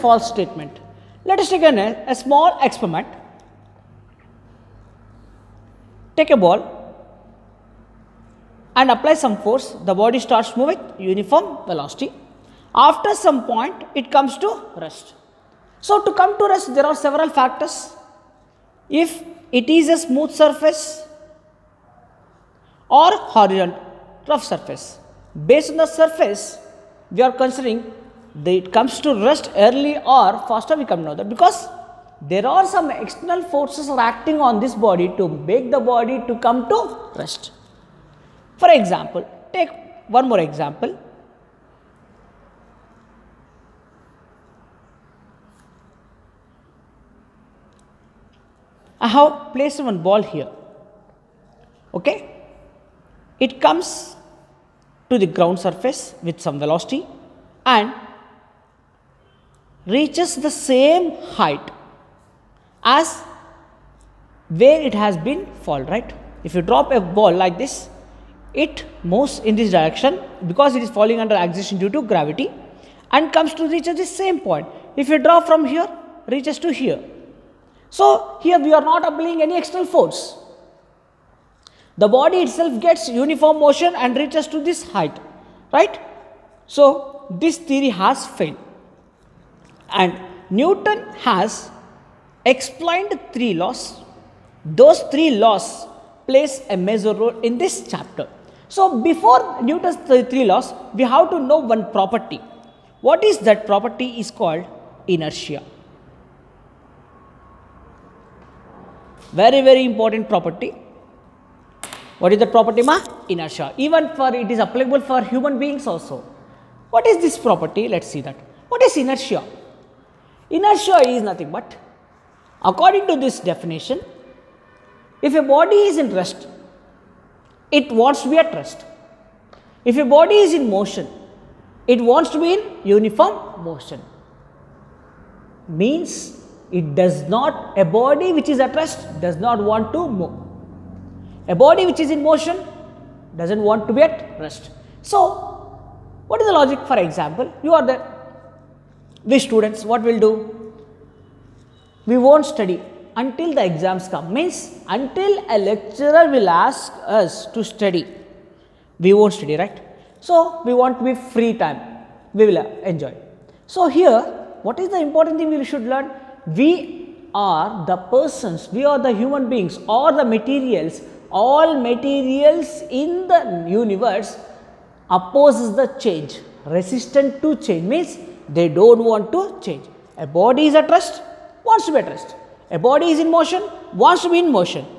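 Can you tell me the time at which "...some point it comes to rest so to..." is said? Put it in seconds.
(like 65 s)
13 s.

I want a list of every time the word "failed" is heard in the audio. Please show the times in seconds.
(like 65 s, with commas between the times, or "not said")
88 s.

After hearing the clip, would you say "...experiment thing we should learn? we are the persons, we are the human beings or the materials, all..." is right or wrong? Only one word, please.
wrong.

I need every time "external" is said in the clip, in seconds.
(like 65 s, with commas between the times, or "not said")
33 s, 79 s.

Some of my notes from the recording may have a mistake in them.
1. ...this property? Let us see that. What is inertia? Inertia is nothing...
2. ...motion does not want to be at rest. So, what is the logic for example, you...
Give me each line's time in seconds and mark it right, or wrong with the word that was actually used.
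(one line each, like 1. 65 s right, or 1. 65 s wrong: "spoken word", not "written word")
1. 117 s right
2. 142 s right.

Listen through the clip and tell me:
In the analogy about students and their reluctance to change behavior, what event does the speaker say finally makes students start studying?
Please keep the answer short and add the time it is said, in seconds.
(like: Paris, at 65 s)
exams, at 153 s.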